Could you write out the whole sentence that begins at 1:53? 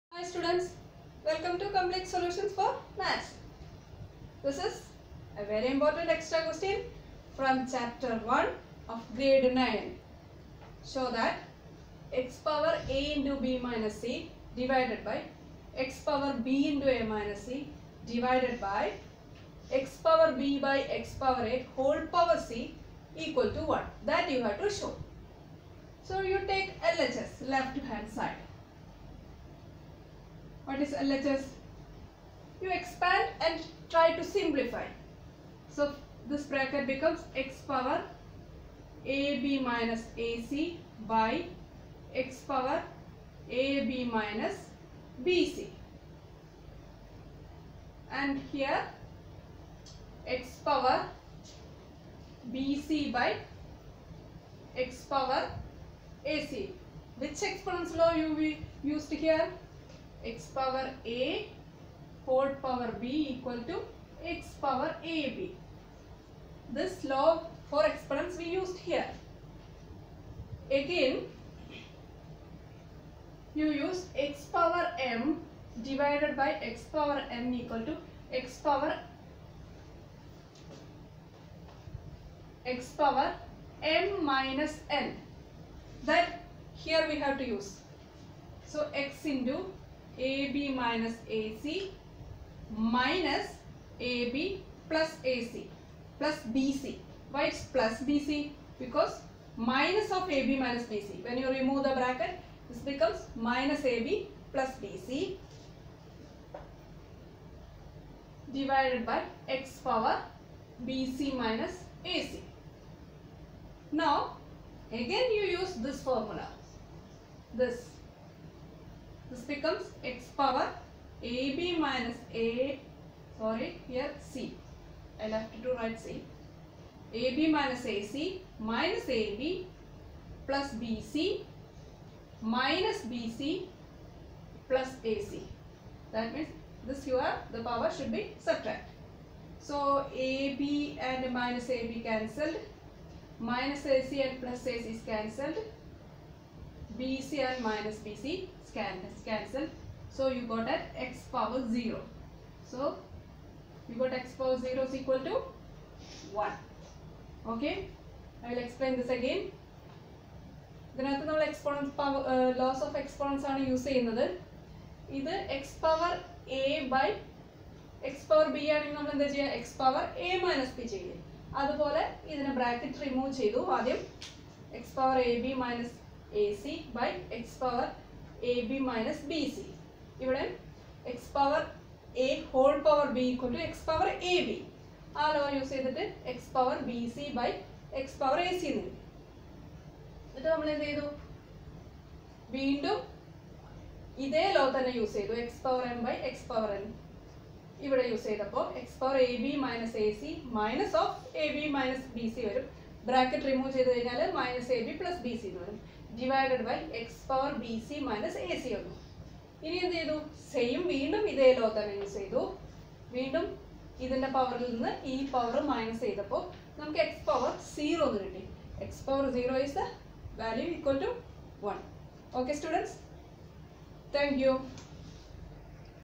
Now, again you use this formula.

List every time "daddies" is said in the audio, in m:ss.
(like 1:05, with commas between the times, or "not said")
not said.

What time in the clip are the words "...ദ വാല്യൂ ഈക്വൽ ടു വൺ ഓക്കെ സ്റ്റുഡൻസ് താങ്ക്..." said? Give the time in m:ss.
3:39.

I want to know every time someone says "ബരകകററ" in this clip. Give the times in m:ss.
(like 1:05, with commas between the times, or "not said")
2:52, 3:23.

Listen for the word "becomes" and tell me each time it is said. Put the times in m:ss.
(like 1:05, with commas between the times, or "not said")
0:36, 1:42, 1:59.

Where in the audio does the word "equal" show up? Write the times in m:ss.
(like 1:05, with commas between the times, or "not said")
0:23, 1:03, 1:17, 2:34.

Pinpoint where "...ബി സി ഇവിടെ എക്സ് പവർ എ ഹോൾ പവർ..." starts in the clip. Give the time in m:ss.
2:59.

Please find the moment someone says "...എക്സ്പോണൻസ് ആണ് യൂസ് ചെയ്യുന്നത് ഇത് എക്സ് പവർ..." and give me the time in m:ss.
2:43.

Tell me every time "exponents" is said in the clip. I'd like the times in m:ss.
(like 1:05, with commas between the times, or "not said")
0:57, 1:07.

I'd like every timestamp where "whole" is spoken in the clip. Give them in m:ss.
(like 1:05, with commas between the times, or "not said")
0:21, 1:02.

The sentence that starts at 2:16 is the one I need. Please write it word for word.
That means this here the power should be subtract So AB and minus AB cancelled, minus AC and plus AC is cancelled.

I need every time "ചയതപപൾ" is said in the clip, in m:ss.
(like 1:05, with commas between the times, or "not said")
3:18, 3:36.